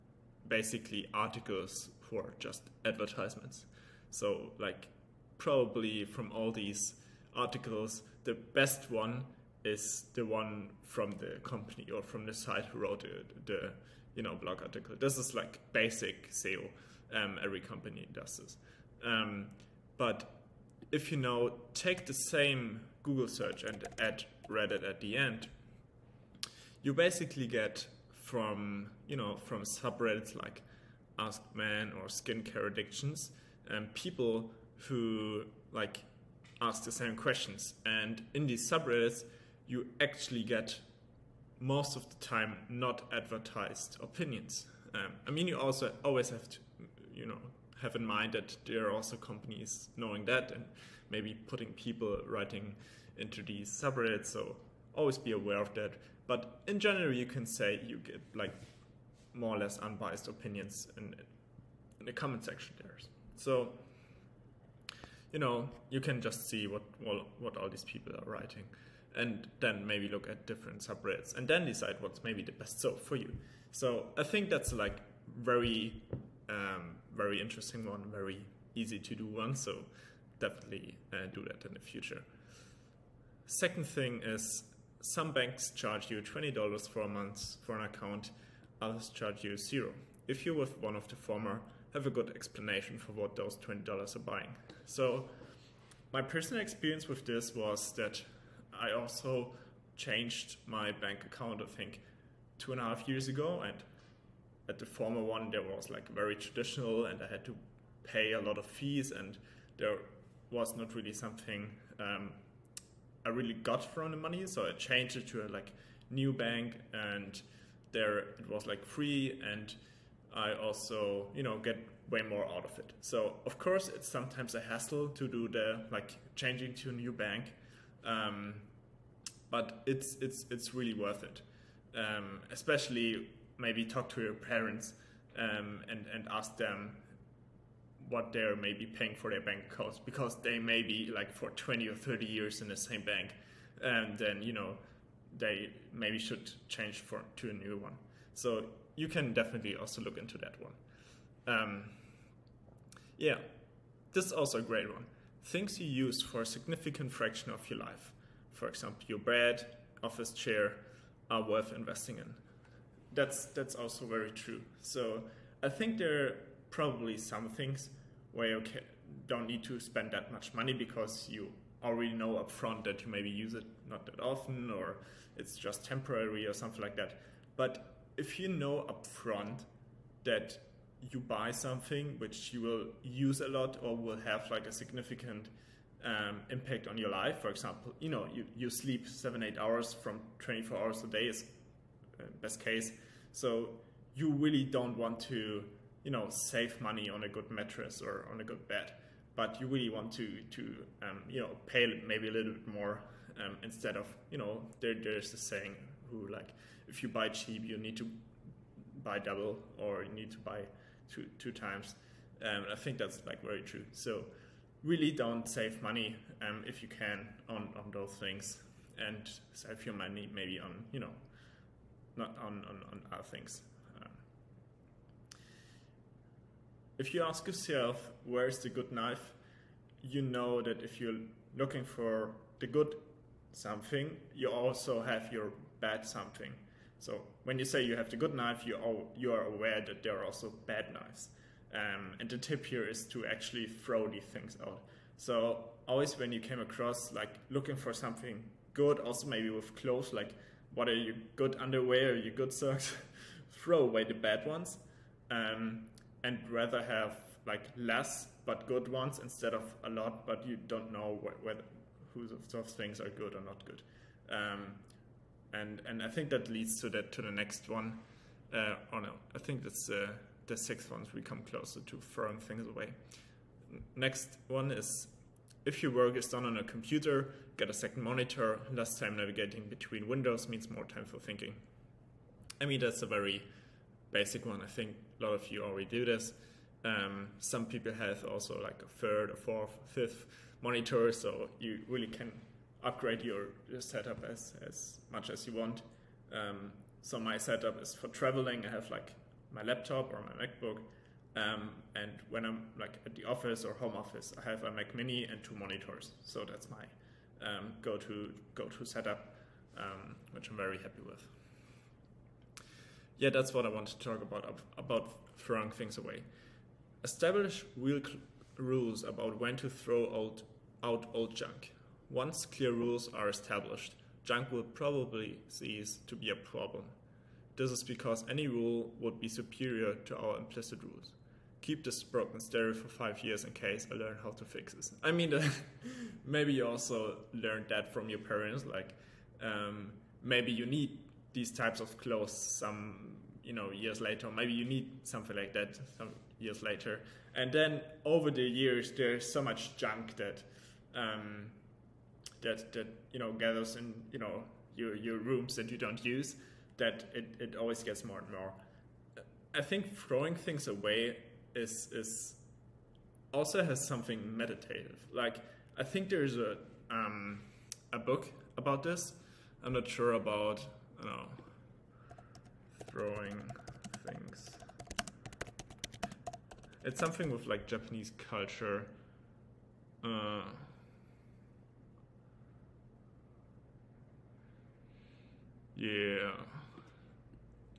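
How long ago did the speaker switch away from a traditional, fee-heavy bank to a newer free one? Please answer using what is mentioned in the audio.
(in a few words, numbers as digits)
2.5 years.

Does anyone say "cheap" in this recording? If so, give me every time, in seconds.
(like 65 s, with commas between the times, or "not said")
207 s.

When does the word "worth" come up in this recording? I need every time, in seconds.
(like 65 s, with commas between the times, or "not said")
130 s, 161 s.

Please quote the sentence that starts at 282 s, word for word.
I mean that's a very basic one.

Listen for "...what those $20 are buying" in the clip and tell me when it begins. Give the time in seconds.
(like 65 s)
93 s.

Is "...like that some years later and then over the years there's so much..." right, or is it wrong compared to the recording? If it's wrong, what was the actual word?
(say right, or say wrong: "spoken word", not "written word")
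right.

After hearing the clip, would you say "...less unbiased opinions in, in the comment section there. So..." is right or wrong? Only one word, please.
right.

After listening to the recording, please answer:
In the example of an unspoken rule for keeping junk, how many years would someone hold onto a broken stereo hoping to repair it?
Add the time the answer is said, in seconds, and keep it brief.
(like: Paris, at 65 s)
5, at 332 s.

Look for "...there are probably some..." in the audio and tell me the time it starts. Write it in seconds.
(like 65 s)
165 s.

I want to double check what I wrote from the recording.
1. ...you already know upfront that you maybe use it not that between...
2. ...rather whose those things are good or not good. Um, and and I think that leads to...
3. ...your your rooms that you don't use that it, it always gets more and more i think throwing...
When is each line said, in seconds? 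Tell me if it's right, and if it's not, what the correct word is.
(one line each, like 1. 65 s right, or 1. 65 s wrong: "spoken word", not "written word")
1. 171 s wrong: "often", not "between"
2. 261 s wrong: "whether", not "rather"
3. 354 s right.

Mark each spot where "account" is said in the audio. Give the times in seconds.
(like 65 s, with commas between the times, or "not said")
87 s, 101 s, 139 s.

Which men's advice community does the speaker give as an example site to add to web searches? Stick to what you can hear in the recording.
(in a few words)
Ask Man.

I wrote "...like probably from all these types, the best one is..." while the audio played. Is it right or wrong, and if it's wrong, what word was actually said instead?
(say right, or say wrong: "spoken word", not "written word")
wrong: "articles", not "types".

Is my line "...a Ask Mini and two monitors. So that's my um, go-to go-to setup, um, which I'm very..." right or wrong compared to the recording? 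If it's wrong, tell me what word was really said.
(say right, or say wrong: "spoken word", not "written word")
wrong: "Mac", not "Ask".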